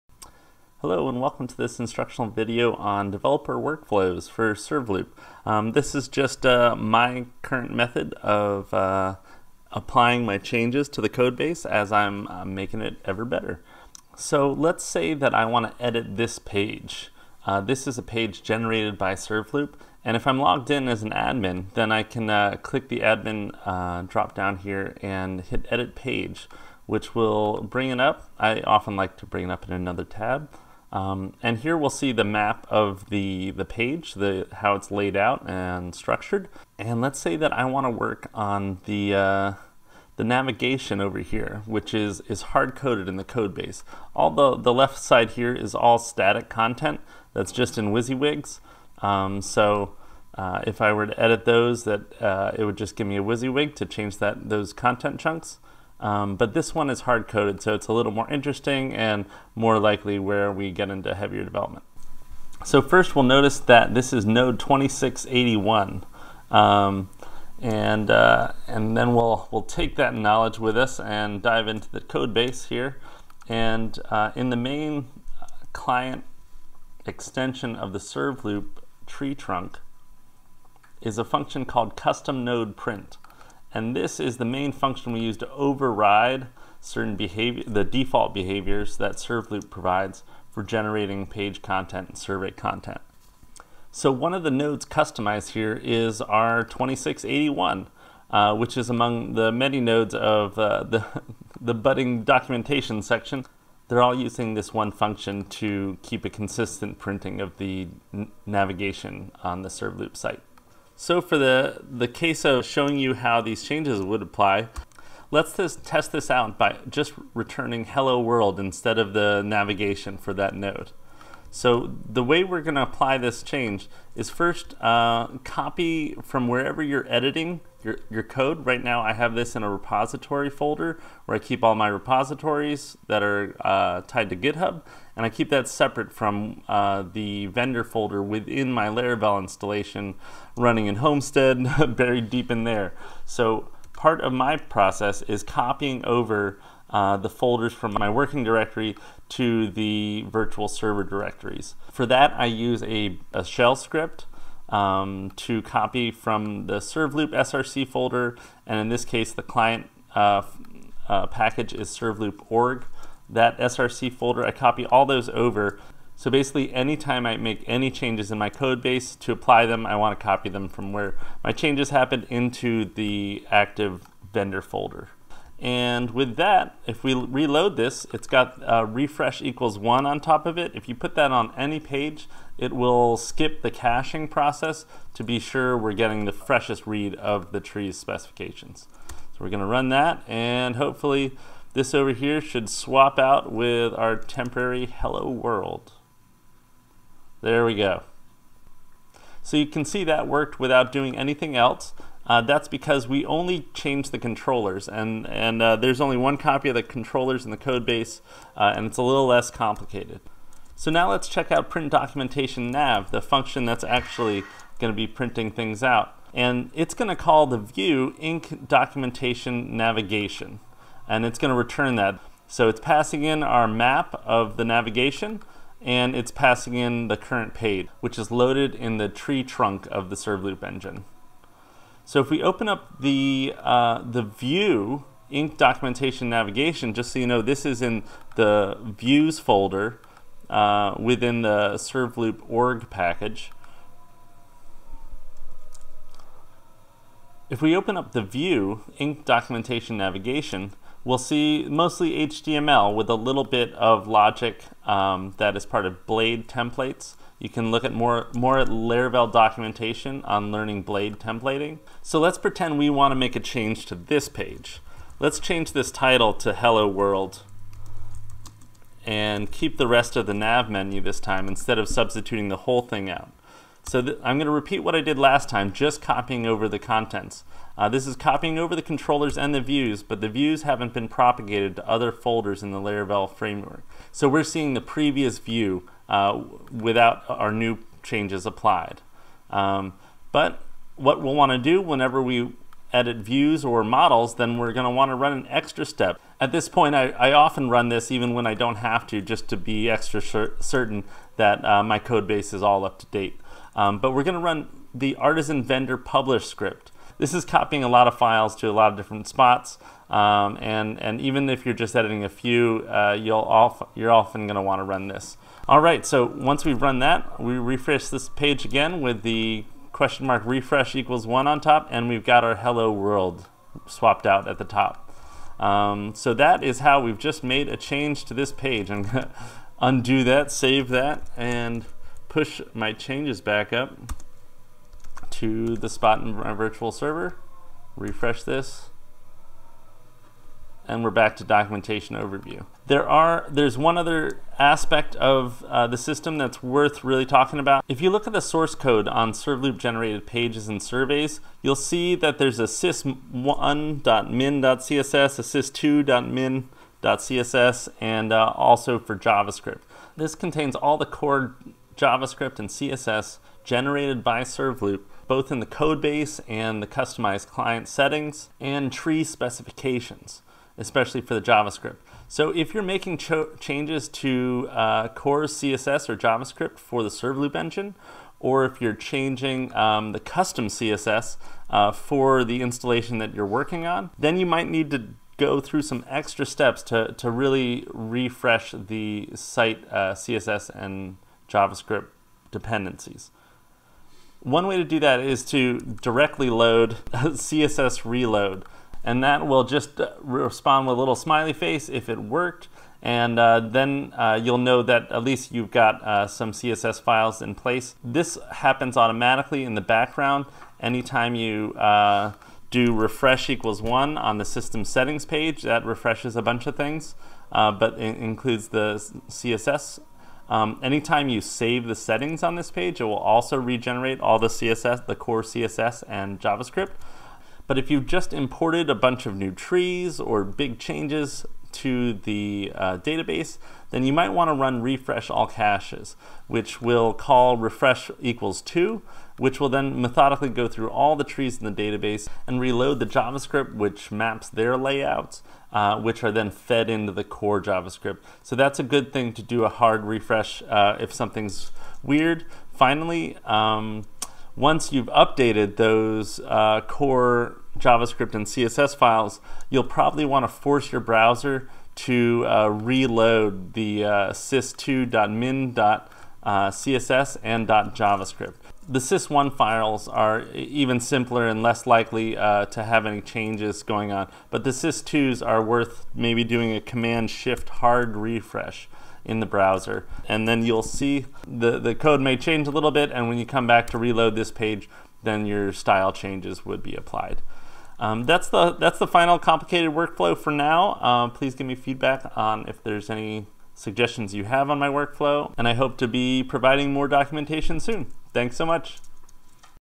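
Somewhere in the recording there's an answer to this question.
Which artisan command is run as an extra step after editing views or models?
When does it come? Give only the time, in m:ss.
5:05.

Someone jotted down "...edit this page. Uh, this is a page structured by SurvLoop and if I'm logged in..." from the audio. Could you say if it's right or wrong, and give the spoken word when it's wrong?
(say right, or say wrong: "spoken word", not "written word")
wrong: "generated", not "structured".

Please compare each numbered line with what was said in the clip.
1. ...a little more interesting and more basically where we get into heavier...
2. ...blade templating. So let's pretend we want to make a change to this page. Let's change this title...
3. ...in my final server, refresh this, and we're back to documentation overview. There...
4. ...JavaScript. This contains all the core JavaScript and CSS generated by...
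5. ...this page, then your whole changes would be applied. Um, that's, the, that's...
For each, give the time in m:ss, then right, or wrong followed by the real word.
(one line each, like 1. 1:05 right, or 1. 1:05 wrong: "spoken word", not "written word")
1. 0:57 wrong: "likely", not "basically"
2. 4:20 right
3. 5:36 wrong: "virtual", not "final"
4. 5:59 right
5. 8:04 wrong: "style", not "whole".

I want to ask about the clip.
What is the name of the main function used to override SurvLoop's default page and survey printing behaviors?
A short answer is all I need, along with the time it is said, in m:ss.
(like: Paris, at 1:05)
custom node print, at 1:21.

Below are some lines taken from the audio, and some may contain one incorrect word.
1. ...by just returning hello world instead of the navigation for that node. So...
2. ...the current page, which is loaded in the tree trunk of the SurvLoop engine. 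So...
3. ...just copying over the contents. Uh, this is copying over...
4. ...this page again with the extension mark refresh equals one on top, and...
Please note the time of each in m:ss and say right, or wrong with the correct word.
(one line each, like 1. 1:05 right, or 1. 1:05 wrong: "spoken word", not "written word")
1. 1:56 right
2. 3:47 right
3. 4:35 right
4. 5:18 wrong: "question", not "extension".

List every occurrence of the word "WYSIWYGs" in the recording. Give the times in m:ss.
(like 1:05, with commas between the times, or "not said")
0:47, 0:53.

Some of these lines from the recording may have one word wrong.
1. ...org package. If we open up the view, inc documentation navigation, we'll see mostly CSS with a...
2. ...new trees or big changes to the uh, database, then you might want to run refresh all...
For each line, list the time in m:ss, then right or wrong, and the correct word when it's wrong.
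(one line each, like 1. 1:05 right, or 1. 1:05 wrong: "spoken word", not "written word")
1. 4:02 wrong: "HTML", not "CSS"
2. 7:09 right.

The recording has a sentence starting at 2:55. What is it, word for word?
And with that, if we reload this, it's got uh, refresh equals one on top of it.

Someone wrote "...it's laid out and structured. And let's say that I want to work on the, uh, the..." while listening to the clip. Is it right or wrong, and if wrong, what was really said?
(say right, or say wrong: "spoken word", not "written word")
right.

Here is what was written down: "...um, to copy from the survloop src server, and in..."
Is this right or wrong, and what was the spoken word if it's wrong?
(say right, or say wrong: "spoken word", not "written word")
wrong: "folder", not "server".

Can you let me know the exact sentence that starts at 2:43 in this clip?
That src folder, I copy all those over.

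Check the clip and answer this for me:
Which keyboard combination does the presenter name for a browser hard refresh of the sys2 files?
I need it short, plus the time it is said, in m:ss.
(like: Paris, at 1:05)
command shift, at 7:56.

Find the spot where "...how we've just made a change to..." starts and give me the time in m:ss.
5:26.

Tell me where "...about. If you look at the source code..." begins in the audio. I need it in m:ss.
5:47.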